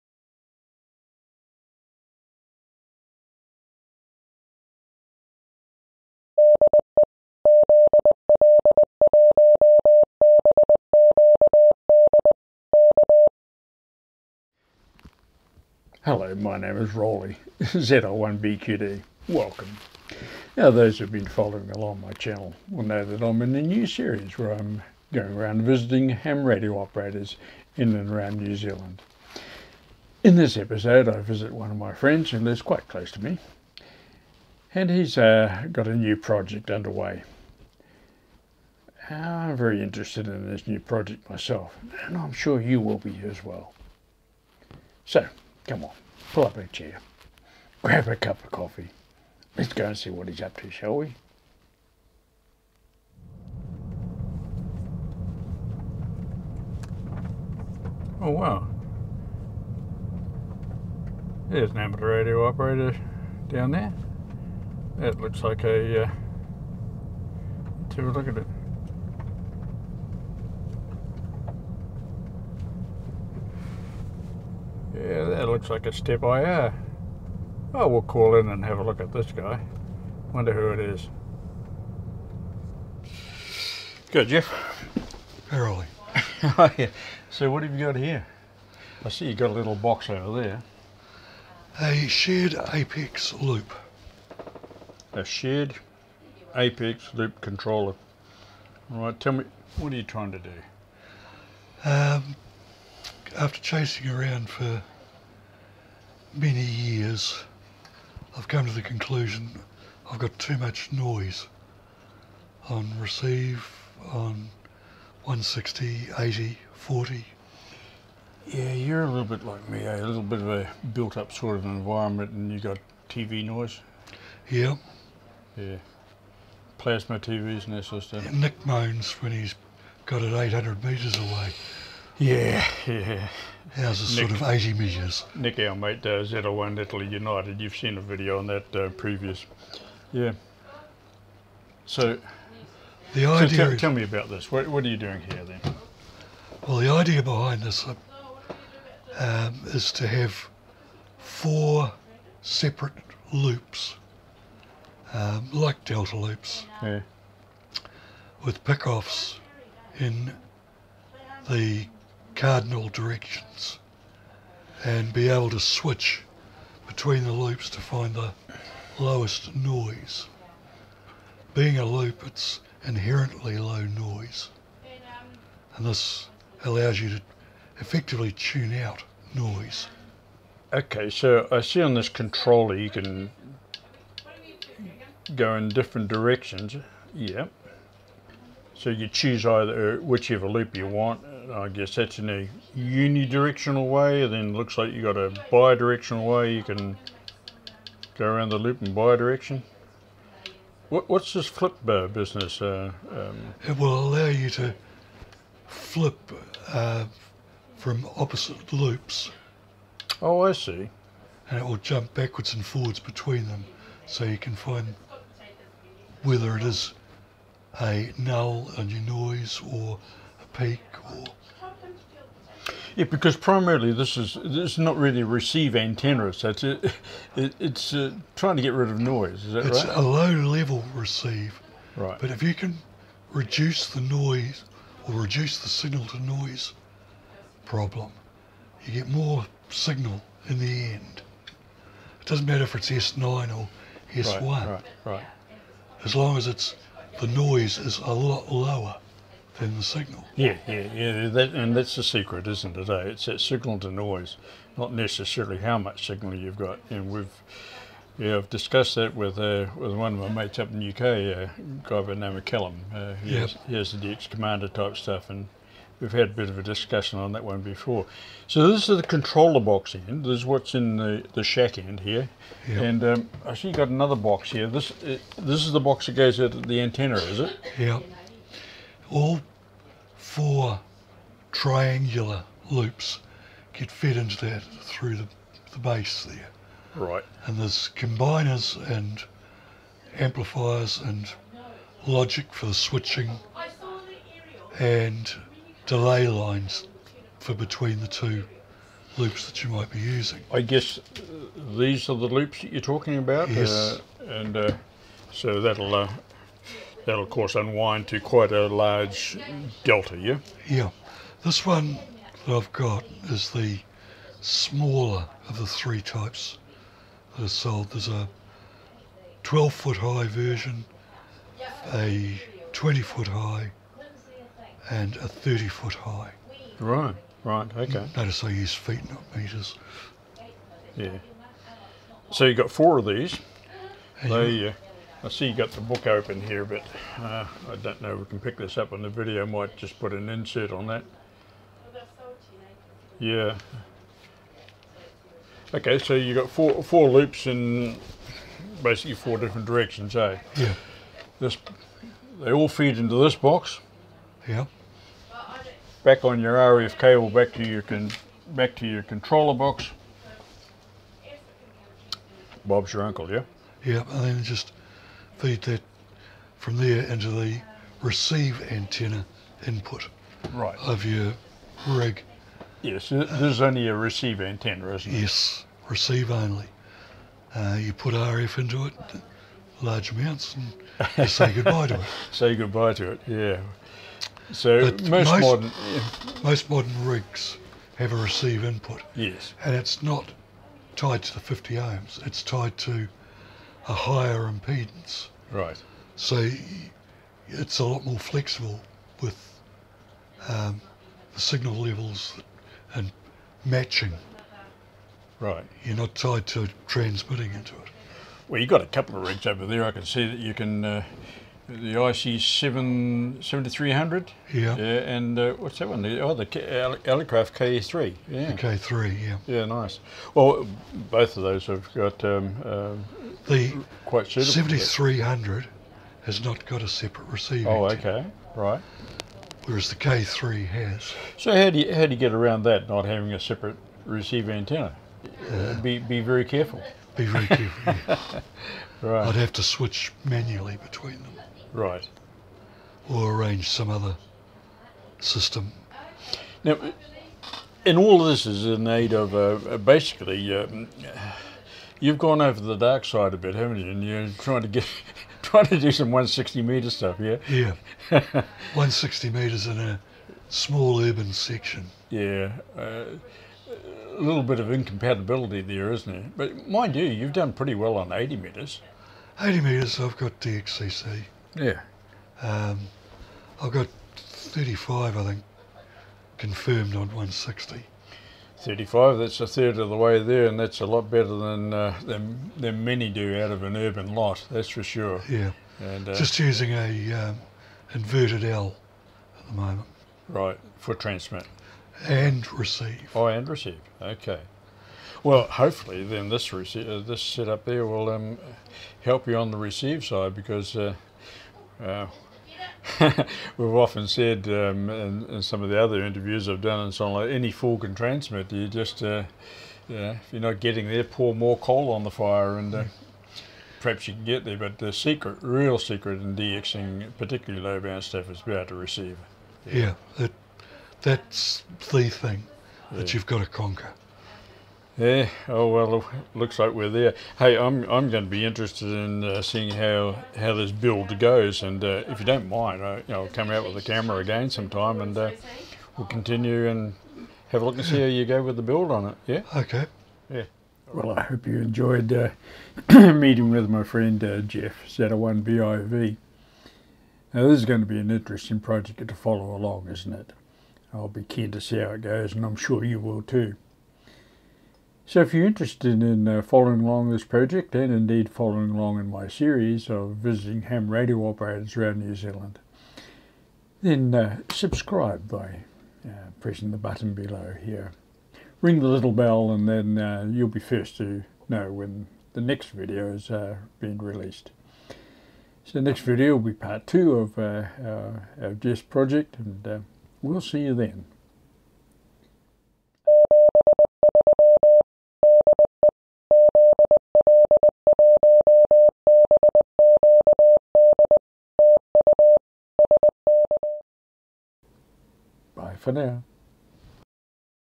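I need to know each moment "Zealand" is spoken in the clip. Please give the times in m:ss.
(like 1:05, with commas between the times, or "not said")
0:28, 9:22.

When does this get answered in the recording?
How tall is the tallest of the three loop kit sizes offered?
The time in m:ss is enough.
5:25.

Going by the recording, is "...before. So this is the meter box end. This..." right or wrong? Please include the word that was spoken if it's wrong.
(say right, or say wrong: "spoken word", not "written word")
wrong: "controller", not "meter".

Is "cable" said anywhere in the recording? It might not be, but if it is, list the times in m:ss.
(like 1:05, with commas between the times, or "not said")
5:56.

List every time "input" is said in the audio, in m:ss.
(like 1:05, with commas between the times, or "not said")
6:09, 6:28.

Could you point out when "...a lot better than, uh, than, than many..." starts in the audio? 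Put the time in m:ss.
8:00.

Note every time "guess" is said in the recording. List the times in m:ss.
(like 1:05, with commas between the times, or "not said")
3:11, 5:00.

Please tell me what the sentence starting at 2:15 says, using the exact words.
Nick, our mate, uh, Z01 Italy United, you've seen a video on that uh, previous.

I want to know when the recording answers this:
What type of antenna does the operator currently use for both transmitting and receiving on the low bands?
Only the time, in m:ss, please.
8:07.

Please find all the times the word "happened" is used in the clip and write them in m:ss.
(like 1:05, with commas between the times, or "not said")
not said.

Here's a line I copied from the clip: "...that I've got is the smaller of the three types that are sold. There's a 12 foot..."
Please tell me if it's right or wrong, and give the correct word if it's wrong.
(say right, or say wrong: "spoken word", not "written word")
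right.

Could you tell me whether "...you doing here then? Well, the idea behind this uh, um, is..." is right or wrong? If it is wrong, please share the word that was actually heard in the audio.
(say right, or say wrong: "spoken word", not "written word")
right.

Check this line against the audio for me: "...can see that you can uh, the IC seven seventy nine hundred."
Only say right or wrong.
wrong.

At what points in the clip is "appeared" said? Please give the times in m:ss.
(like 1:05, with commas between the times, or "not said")
not said.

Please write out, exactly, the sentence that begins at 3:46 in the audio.
It's a, it, it's uh, trying to get rid of noise.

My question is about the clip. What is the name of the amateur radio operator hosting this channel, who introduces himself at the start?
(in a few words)
Roly.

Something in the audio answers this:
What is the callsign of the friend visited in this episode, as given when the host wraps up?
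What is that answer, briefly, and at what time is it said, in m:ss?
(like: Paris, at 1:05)
ZL1BIV, at 9:04.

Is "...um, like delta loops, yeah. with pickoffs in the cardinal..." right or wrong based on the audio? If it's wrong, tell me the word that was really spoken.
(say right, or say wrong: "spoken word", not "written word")
right.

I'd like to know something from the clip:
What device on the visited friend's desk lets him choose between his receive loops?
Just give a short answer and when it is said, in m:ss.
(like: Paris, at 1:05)
A shared apex loop controller, at 1:35.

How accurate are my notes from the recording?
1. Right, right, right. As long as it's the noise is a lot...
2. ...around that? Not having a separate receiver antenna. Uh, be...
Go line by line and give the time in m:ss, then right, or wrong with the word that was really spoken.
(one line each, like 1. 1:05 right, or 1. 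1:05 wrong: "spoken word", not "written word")
1. 4:04 right
2. 7:12 right.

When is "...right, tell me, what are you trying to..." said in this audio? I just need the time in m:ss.
1:39.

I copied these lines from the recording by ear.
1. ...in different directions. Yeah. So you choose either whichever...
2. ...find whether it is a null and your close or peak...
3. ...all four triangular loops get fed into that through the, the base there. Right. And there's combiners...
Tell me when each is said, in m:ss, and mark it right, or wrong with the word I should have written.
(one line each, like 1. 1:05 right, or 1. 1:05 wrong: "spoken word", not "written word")
1. 3:05 right
2. 3:34 wrong: "noise", not "close"
3. 4:39 right.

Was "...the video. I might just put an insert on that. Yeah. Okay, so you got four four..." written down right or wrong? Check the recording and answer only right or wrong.
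right.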